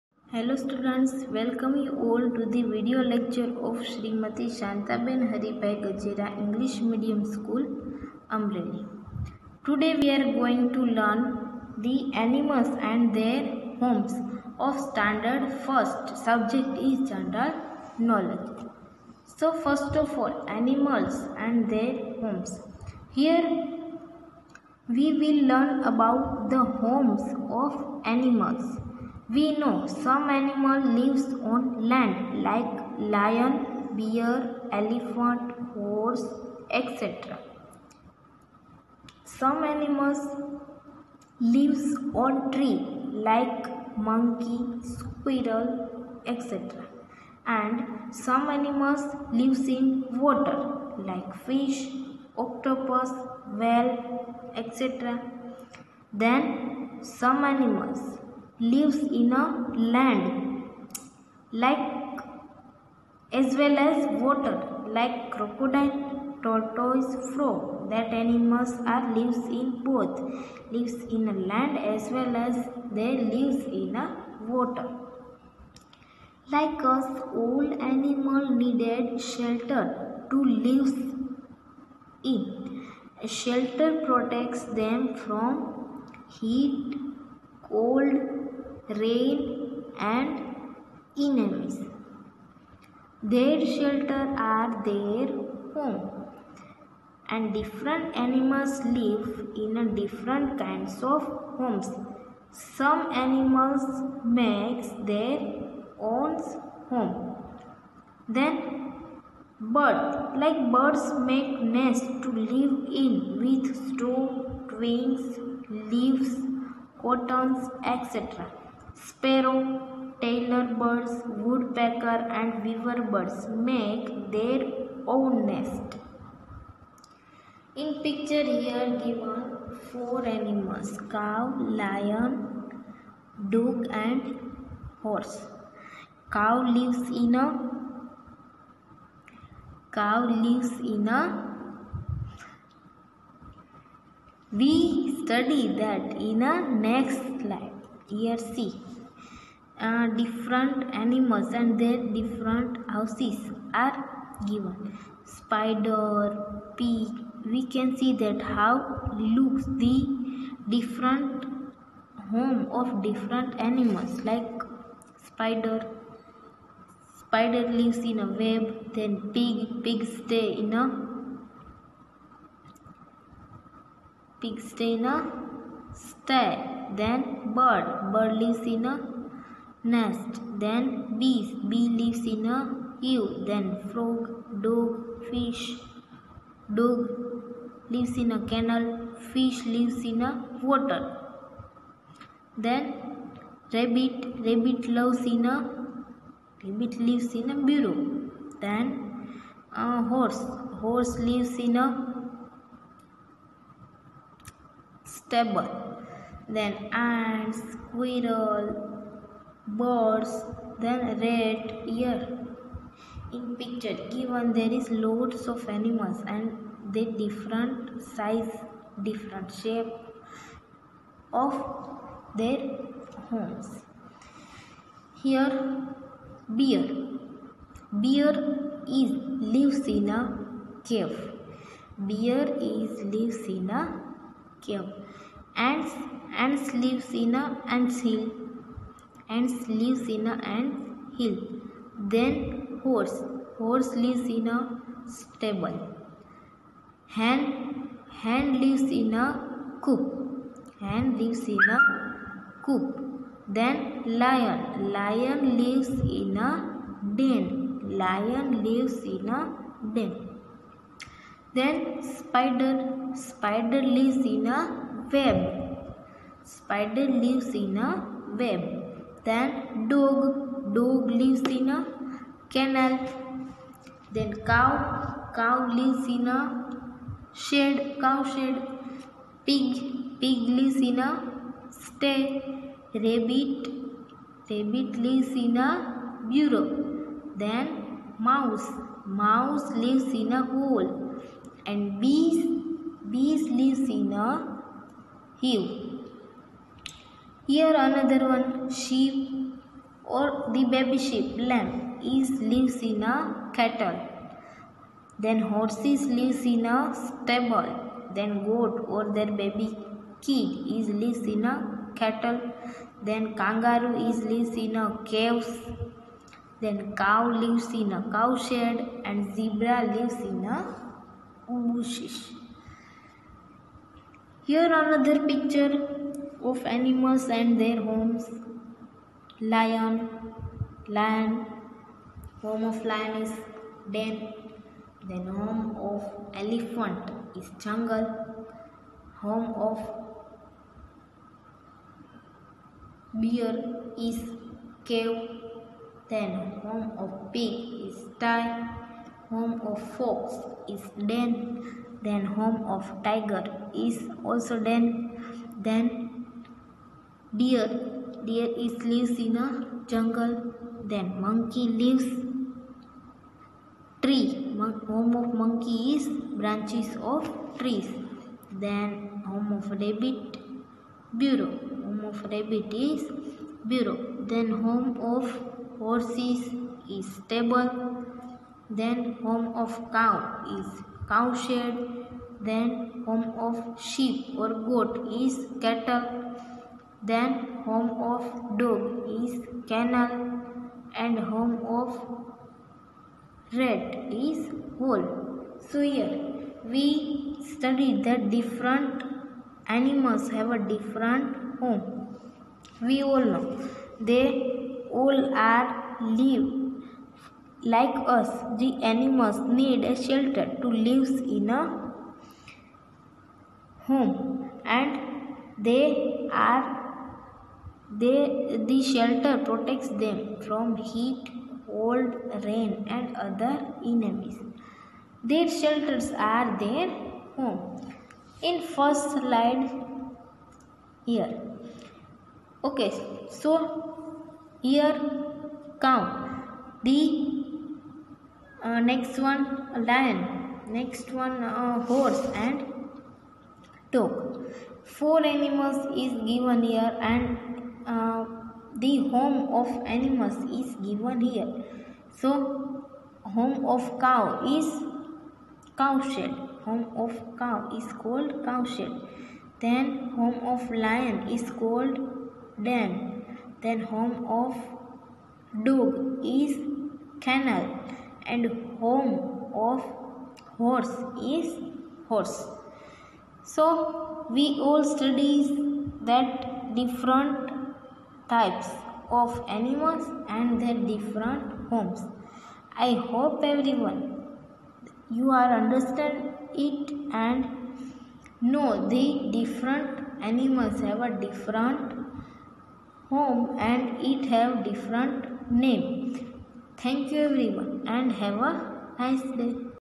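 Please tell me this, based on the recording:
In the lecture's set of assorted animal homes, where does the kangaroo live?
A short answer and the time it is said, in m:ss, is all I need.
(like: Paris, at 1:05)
caves, at 5:13.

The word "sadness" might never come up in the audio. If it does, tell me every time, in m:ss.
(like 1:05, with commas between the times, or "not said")
not said.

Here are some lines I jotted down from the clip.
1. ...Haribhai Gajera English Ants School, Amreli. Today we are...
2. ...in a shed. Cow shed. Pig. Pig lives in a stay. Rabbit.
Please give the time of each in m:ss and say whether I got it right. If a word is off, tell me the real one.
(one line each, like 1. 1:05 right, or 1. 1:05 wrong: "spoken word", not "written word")
1. 0:05 wrong: "Medium", not "Ants"
2. 4:36 right.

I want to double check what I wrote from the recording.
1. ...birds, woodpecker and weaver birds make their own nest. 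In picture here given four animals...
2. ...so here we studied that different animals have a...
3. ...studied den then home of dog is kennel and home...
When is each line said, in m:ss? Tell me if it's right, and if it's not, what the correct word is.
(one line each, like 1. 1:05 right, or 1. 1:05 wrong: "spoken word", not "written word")
1. 2:00 right
2. 6:35 right
3. 7:41 wrong: "called", not "studied".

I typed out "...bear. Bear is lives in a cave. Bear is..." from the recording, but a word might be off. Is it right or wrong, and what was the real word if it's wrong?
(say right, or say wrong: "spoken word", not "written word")
right.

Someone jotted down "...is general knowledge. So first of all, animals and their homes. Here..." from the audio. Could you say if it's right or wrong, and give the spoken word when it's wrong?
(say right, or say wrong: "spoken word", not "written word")
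right.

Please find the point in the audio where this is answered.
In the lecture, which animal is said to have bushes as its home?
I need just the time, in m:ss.
5:19.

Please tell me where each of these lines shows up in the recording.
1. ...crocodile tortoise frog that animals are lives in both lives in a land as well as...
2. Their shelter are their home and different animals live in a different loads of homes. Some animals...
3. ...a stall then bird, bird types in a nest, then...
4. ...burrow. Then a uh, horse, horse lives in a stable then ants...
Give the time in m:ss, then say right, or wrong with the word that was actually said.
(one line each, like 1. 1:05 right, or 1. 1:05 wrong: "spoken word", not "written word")
1. 1:05 right
2. 1:33 wrong: "kinds", not "loads"
3. 2:55 wrong: "lives", not "types"
4. 3:17 right.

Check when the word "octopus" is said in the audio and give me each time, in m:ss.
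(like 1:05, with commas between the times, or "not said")
0:52.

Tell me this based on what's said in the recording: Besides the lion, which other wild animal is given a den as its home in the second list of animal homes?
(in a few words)
fox.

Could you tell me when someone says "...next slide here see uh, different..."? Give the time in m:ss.
2:26.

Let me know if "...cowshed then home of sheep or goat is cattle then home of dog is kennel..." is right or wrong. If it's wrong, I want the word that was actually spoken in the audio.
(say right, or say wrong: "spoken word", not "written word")
right.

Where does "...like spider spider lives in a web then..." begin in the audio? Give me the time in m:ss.
2:44.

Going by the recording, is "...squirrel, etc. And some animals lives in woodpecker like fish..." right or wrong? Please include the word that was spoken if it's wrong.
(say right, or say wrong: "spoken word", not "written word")
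wrong: "water", not "woodpecker".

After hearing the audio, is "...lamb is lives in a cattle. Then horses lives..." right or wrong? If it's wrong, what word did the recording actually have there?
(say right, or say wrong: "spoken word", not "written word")
right.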